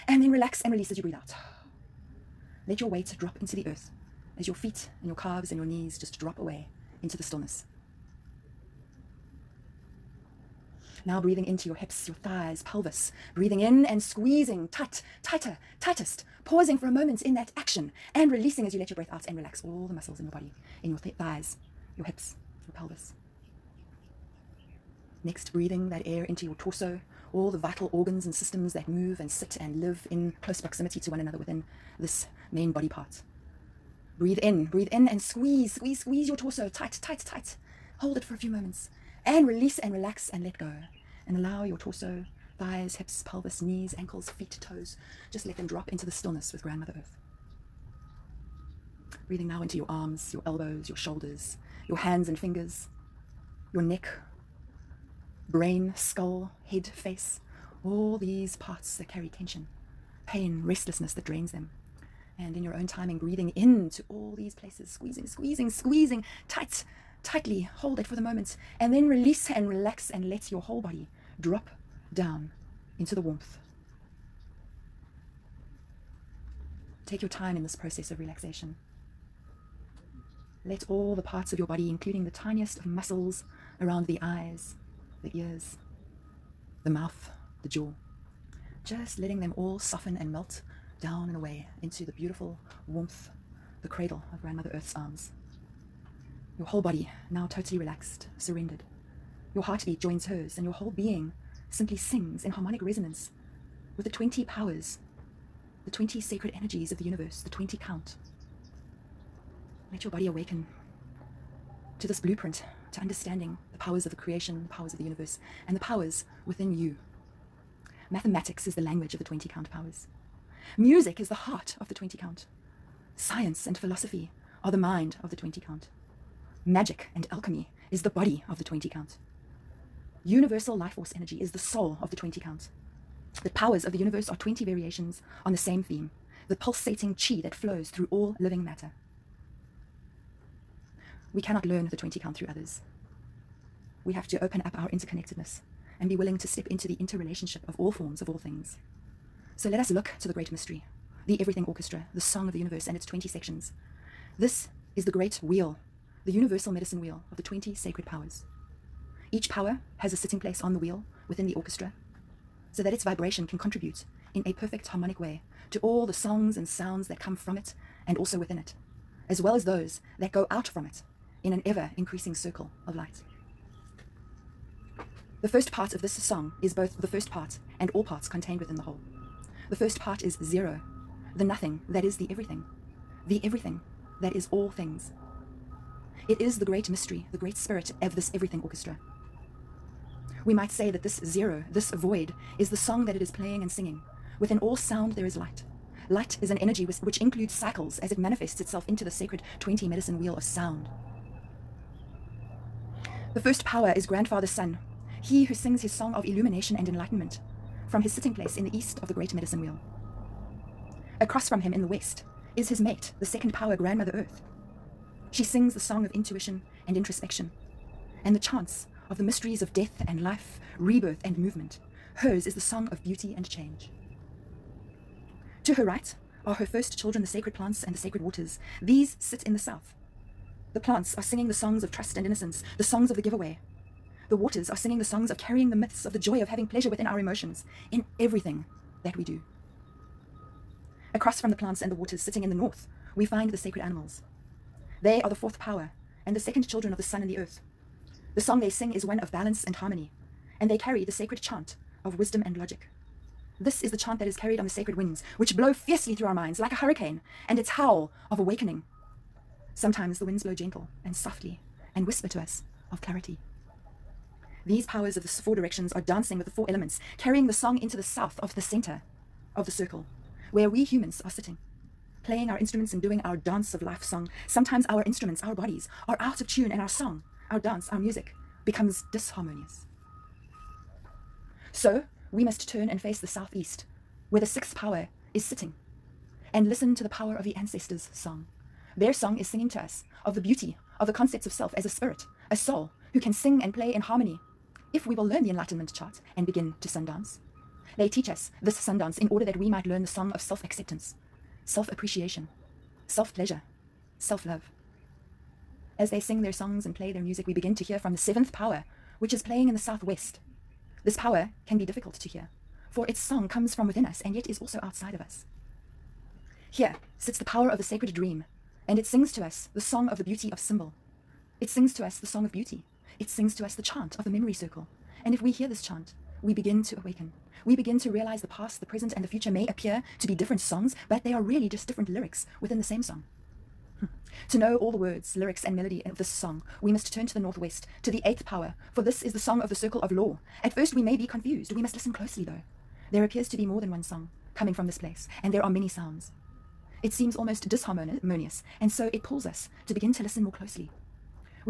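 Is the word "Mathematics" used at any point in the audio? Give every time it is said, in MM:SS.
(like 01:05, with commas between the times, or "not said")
01:58.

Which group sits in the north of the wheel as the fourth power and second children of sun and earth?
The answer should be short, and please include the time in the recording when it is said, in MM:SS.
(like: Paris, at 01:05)
sacred animals, at 04:03.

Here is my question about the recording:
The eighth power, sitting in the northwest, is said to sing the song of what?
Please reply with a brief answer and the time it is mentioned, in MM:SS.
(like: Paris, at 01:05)
circle of law, at 05:39.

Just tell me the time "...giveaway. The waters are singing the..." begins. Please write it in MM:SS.
03:53.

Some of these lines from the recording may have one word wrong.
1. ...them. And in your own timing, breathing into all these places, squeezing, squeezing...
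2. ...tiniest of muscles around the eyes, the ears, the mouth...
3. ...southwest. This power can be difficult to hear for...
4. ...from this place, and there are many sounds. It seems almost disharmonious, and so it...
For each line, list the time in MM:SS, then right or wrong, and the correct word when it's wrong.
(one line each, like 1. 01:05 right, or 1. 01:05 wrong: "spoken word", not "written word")
1. 01:01 right
2. 01:22 right
3. 05:09 right
4. 05:44 right.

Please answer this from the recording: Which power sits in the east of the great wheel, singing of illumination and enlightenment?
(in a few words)
Grandfather Sun.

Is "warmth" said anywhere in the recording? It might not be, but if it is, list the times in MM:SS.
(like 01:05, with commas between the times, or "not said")
01:13, 01:32.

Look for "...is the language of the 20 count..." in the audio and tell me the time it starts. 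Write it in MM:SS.
01:58.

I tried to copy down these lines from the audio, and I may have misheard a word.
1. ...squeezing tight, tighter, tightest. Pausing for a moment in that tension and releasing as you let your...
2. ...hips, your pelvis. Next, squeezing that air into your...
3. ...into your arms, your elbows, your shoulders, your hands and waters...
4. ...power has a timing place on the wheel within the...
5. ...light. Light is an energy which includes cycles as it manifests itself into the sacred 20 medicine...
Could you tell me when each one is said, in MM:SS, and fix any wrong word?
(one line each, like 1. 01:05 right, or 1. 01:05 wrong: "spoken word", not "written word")
1. 00:14 wrong: "action", not "tension"
2. 00:22 wrong: "breathing", not "squeezing"
3. 00:49 wrong: "fingers", not "waters"
4. 02:39 wrong: "sitting", not "timing"
5. 03:15 right.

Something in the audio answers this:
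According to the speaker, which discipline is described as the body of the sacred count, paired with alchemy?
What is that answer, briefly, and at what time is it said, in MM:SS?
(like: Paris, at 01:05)
Magic, at 02:06.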